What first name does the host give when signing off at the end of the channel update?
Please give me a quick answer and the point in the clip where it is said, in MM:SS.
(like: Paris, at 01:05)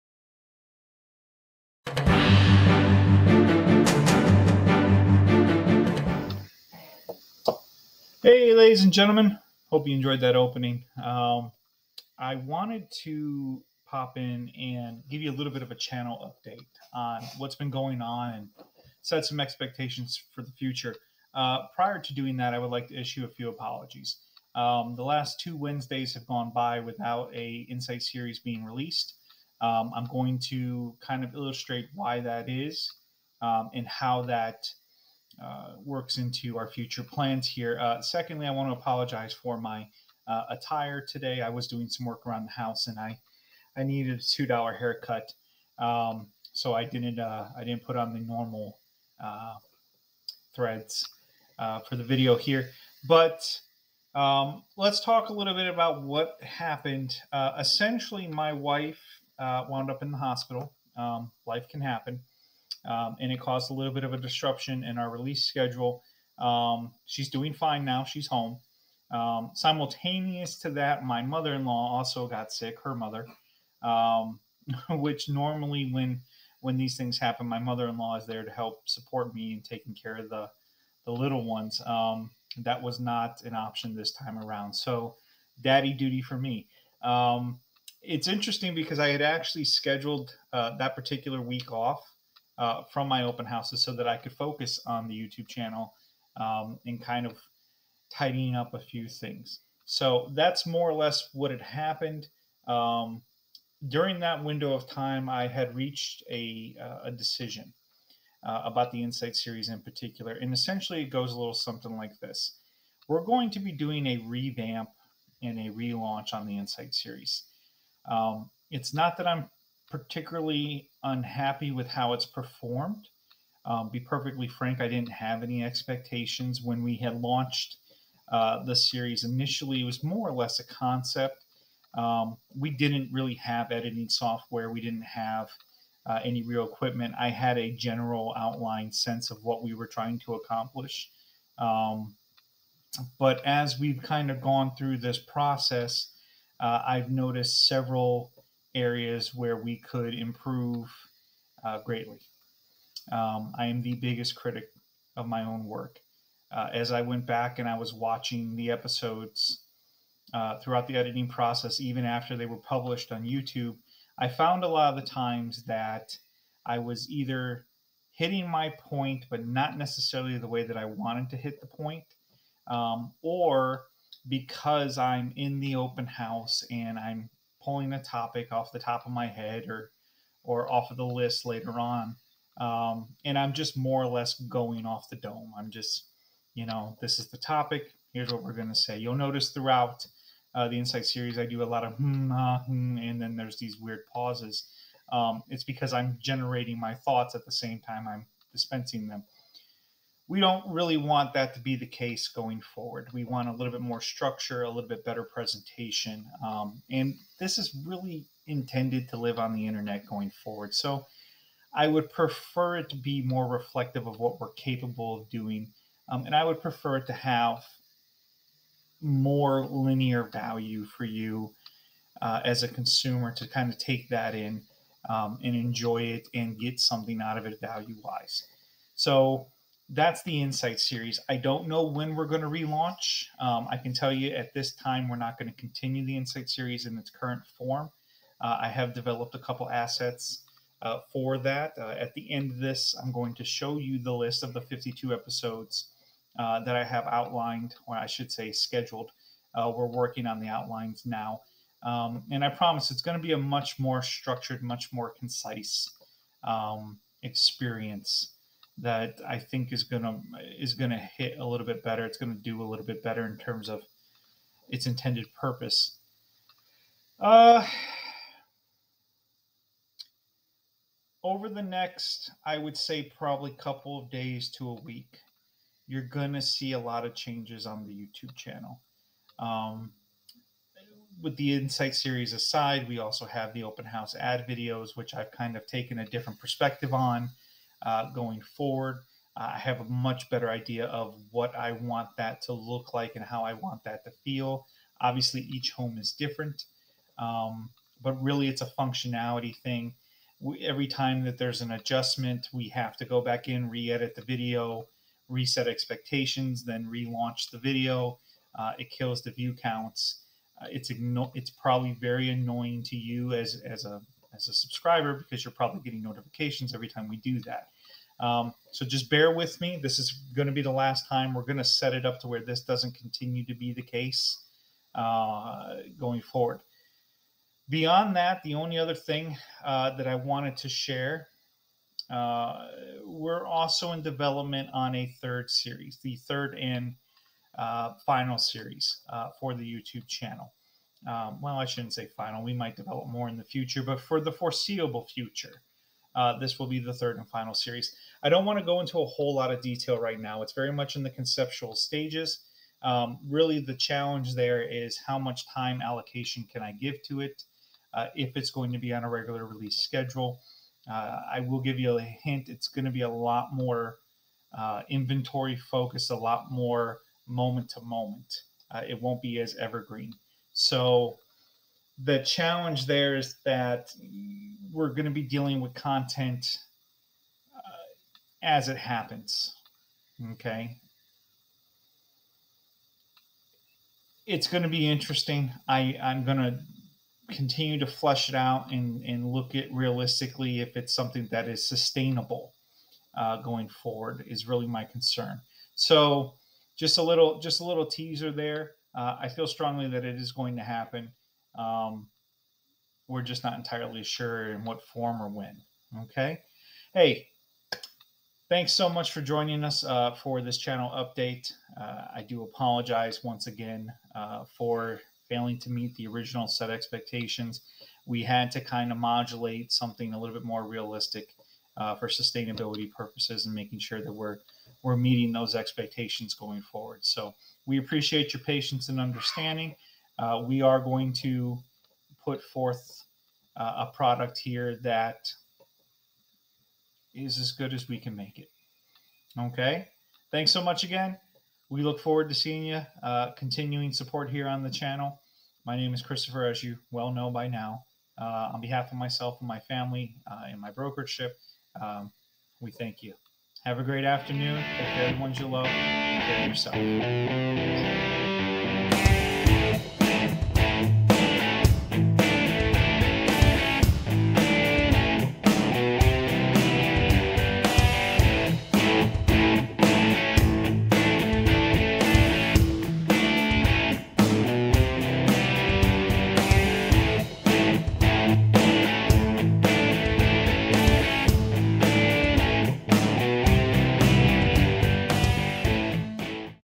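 Christopher, at 07:26.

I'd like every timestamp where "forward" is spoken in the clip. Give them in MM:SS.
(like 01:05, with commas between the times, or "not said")
03:22, 03:30, 04:48, 05:26, 06:33, 07:06, 07:21.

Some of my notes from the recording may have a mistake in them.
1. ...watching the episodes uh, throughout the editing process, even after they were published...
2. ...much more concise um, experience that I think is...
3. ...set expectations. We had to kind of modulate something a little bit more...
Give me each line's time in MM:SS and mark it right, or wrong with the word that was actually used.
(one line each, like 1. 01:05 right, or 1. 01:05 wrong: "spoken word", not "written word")
1. 02:37 right
2. 04:14 right
3. 06:56 right.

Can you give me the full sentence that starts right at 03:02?
Um, and I'm just more or less going off the dome.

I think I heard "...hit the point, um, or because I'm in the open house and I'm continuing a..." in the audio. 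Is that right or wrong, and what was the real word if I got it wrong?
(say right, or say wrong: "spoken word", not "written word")
wrong: "pulling", not "continuing".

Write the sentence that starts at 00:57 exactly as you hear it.
essentially, my wife wound up in the hospital.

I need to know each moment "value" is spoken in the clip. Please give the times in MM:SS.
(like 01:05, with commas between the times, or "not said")
03:40, 03:47.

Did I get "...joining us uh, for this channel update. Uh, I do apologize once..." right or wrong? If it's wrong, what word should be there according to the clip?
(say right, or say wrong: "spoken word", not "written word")
right.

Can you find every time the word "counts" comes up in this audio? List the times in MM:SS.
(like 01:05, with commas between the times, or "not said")
05:09.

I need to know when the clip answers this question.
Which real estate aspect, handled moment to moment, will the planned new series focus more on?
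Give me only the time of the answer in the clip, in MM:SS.
06:04.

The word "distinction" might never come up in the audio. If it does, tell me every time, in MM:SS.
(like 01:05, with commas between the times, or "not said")
not said.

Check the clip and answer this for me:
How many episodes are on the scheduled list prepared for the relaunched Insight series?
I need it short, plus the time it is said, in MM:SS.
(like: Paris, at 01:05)
52, at 04:04.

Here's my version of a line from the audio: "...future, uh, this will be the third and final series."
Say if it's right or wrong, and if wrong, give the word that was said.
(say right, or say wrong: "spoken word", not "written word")
right.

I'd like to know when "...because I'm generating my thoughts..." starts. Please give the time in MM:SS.
03:15.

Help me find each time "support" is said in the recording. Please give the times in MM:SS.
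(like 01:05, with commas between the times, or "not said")
01:18, 07:23.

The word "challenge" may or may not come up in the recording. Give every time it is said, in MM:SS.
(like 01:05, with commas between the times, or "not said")
05:53, 06:12.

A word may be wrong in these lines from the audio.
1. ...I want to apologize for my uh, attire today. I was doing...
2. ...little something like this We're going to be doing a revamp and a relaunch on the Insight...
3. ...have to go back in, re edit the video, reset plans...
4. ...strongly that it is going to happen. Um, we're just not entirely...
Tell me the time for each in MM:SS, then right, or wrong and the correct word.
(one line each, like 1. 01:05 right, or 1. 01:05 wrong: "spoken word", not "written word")
1. 00:38 right
2. 01:51 right
3. 05:02 wrong: "expectations", not "plans"
4. 06:39 right.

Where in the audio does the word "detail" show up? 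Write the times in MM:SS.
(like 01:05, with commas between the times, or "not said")
05:49.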